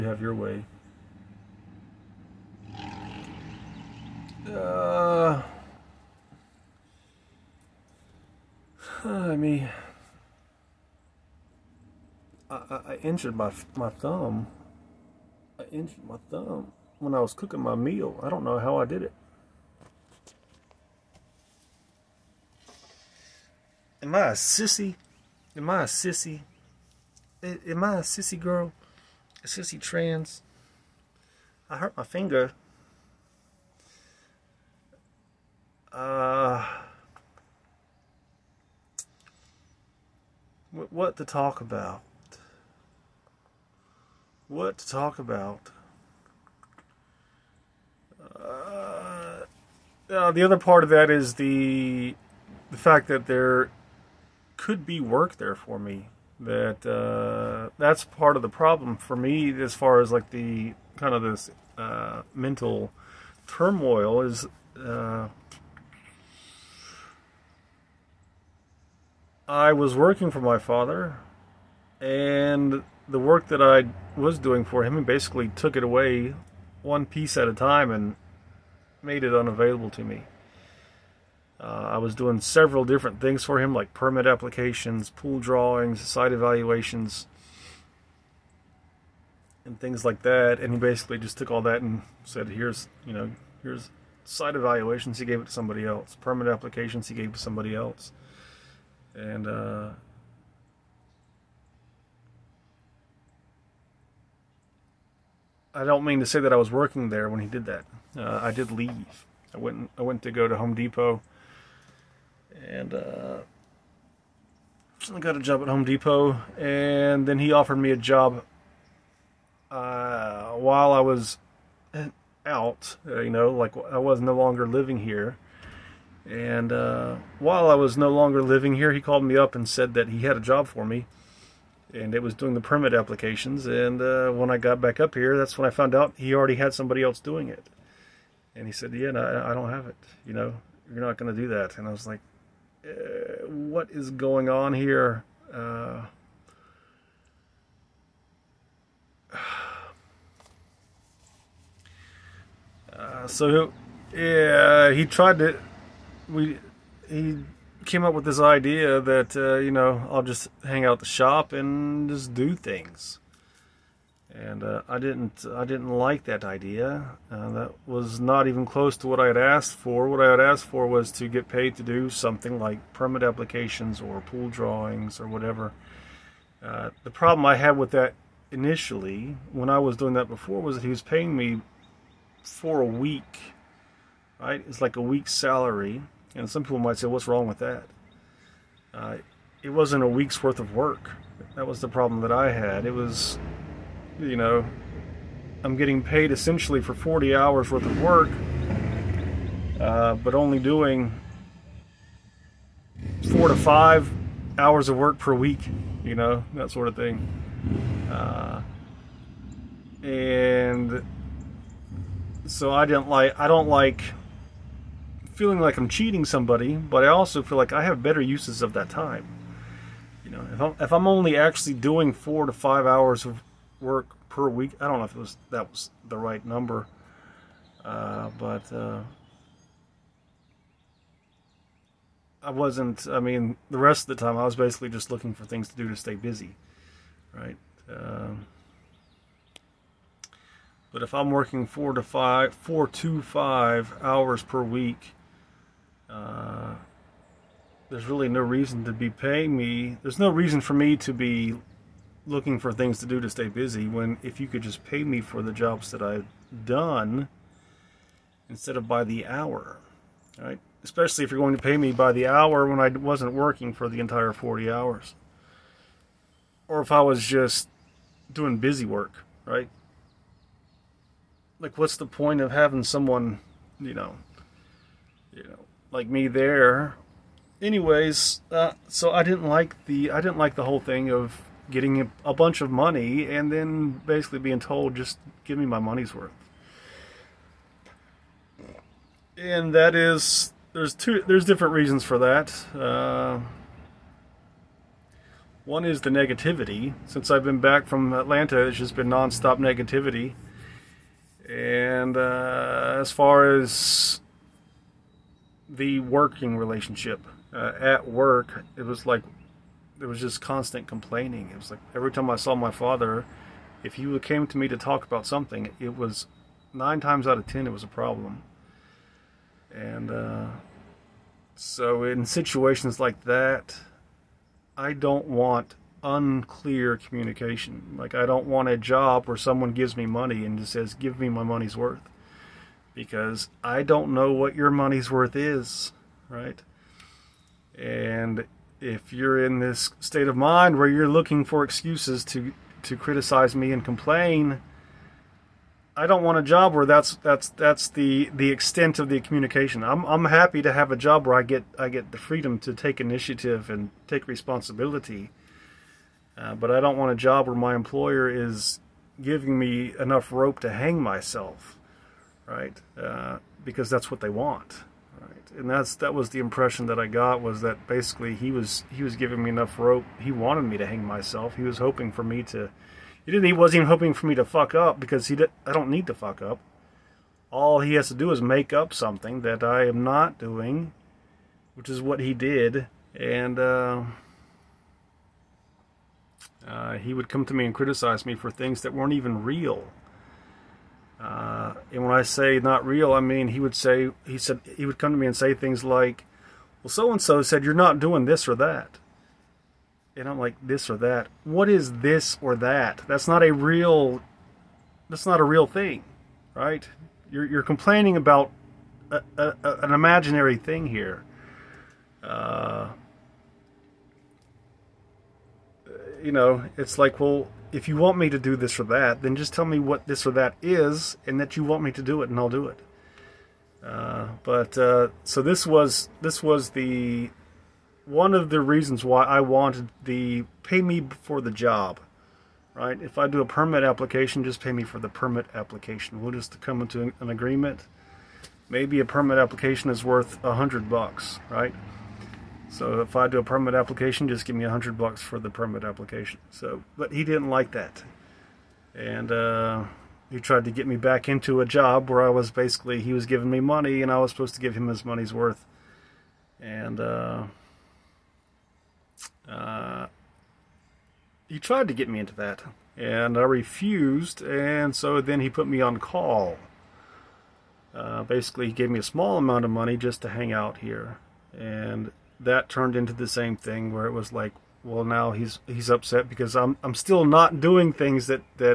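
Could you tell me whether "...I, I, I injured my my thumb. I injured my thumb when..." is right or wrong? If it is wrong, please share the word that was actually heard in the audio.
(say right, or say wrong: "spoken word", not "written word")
right.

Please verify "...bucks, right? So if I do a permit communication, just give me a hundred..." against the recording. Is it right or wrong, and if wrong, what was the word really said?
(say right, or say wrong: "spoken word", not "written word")
wrong: "application", not "communication".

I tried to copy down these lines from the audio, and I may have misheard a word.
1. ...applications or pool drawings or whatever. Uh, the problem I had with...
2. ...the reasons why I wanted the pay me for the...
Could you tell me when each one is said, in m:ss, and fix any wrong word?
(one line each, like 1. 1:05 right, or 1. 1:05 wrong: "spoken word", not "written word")
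1. 2:53 right
2. 7:08 right.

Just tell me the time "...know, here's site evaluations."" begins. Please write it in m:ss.
1:33.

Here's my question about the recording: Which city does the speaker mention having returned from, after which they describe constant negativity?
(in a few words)
Atlanta.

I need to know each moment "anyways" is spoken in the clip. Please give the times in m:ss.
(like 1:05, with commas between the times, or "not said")
4:37.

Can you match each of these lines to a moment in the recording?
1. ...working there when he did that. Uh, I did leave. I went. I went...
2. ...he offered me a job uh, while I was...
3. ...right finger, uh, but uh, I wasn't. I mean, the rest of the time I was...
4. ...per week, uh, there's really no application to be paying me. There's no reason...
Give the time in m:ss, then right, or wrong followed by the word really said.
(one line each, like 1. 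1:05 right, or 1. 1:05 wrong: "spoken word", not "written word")
1. 1:46 right
2. 1:57 right
3. 3:46 wrong: "number", not "finger"
4. 4:04 wrong: "reason", not "application".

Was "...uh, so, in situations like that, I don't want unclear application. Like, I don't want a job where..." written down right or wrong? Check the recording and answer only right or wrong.
wrong.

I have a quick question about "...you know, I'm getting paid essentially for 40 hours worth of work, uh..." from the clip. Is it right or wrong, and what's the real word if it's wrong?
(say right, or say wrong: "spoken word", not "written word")
right.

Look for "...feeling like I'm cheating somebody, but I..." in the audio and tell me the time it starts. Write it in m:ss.
3:35.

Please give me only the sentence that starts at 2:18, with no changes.
And he said, "Yeah, no, I don't have it.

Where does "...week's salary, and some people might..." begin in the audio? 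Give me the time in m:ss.
3:05.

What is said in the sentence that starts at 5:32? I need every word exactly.
Because I don't know what your money's worth is, right?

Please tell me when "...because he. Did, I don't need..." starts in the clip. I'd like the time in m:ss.
6:14.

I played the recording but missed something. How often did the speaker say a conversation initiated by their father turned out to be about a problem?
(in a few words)
9 times out of 10.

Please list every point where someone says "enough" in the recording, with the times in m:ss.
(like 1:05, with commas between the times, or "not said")
5:59, 6:09.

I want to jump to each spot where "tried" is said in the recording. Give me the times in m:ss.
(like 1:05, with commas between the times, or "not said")
2:35, 7:30, 7:41.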